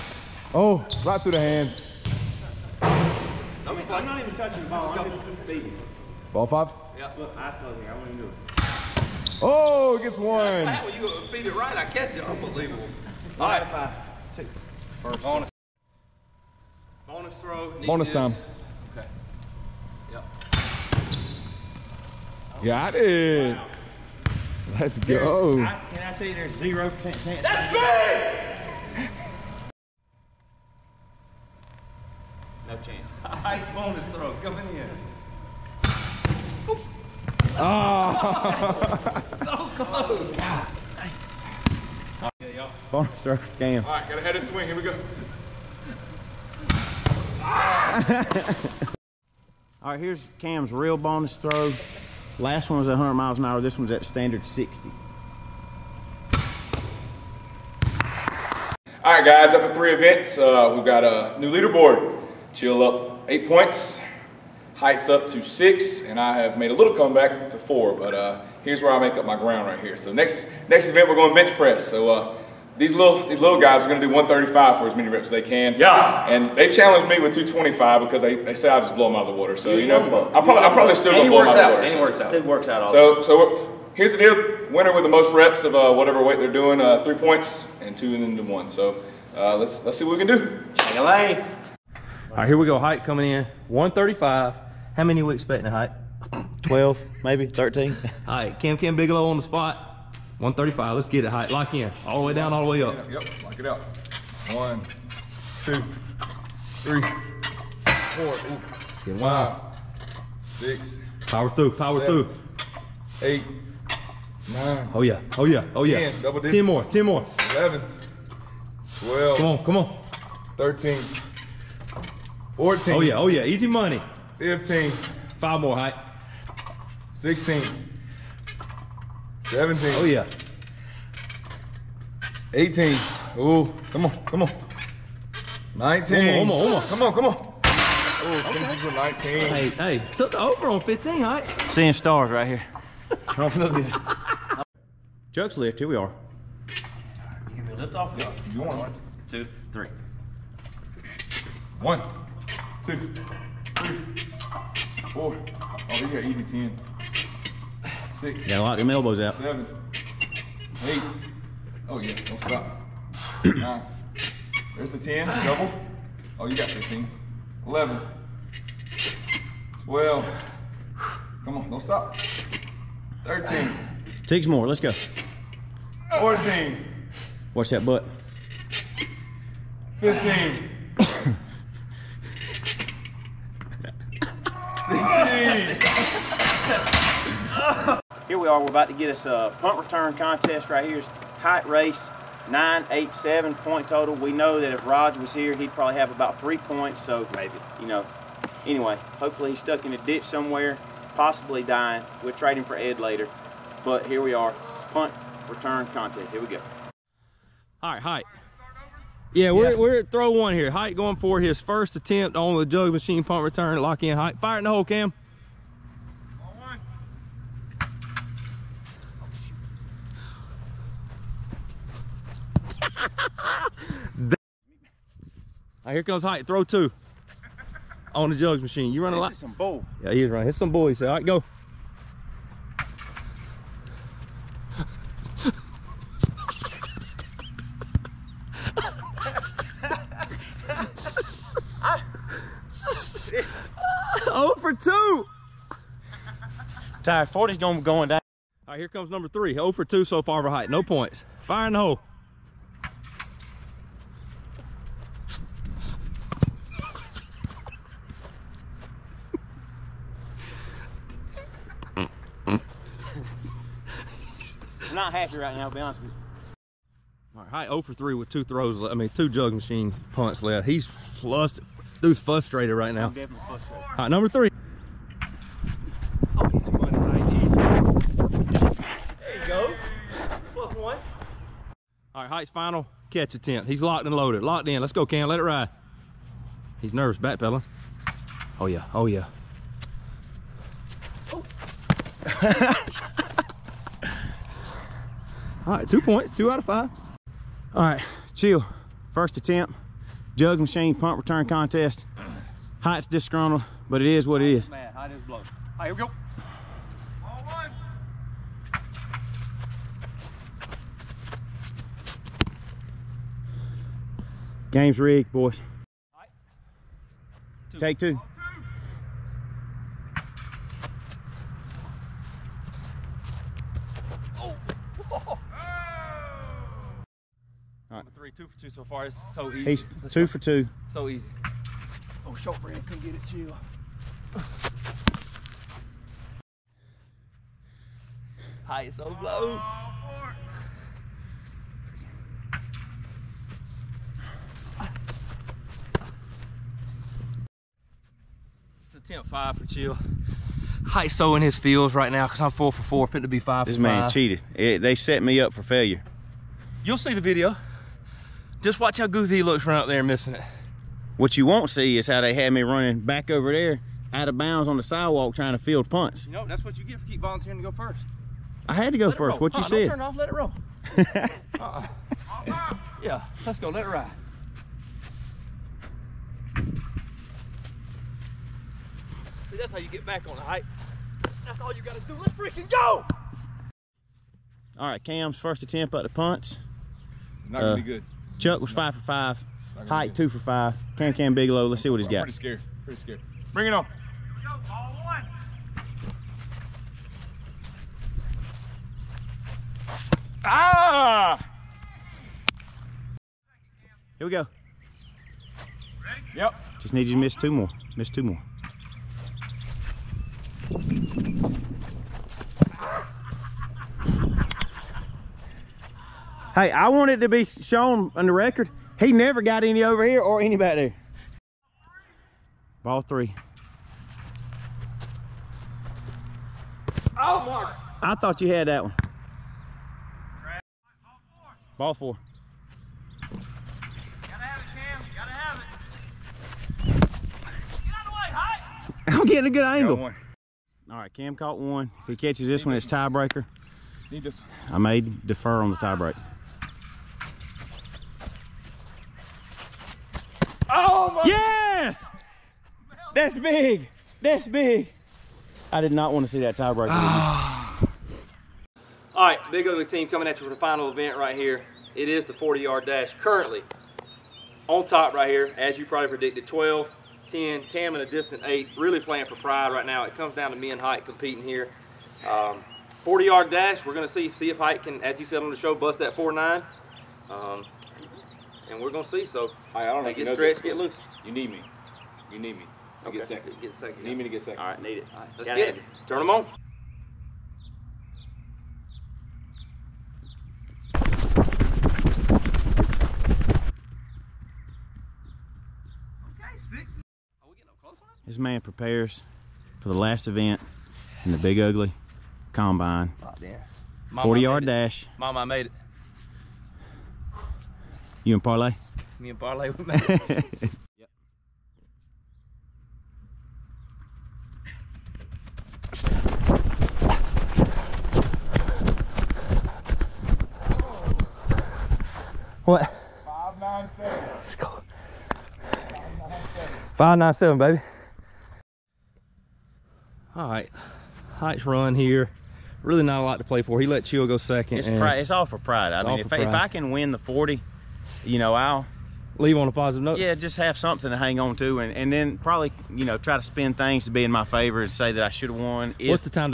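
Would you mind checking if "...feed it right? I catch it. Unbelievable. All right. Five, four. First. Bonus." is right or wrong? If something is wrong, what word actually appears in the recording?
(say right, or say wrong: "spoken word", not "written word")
wrong: "two", not "four".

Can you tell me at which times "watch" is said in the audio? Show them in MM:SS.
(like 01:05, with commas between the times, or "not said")
02:57, 05:58.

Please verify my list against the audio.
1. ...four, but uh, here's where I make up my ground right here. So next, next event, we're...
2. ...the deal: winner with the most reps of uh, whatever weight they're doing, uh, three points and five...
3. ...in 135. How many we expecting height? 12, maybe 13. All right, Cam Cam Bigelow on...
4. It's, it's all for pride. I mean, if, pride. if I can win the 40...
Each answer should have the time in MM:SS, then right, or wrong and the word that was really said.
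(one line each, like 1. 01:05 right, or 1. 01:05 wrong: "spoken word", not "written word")
1. 01:07 right
2. 01:24 wrong: "two", not "five"
3. 01:33 right
4. 08:54 right.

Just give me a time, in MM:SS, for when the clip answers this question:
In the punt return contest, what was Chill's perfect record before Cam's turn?
06:28.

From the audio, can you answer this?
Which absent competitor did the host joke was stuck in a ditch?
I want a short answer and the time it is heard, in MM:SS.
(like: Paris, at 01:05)
Rod, at 03:14.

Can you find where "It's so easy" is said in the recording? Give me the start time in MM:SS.
05:29.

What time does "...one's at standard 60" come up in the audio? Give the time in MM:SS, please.
00:53.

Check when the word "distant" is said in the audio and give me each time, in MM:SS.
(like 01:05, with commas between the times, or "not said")
07:48.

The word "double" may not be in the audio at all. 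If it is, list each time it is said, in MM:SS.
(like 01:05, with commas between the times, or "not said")
01:56, 02:45.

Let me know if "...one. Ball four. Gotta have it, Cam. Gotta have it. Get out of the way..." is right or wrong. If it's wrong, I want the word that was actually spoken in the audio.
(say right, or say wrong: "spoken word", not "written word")
right.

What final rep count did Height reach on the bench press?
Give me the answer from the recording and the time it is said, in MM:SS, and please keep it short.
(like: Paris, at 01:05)
19, at 02:18.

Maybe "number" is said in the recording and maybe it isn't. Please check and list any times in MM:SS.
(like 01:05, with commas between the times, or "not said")
04:09, 04:34.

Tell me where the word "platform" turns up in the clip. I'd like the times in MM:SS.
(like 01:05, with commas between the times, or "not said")
not said.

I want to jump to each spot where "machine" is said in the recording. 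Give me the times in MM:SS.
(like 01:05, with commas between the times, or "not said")
03:32, 03:48, 04:29, 05:00.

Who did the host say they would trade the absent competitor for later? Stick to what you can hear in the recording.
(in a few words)
Ed.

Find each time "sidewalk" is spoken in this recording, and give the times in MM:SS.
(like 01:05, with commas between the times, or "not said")
06:04.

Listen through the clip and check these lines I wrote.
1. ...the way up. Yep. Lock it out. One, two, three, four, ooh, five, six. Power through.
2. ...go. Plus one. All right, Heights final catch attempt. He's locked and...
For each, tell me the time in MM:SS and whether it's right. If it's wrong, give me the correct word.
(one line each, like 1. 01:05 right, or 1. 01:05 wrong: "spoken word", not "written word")
1. 01:42 right
2. 04:39 right.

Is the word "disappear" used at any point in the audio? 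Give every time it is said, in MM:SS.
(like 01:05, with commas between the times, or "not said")
not said.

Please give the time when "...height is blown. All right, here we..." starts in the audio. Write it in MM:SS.
05:04.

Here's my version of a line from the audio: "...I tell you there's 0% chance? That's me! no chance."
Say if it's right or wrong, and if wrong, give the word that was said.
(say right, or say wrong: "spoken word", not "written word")
right.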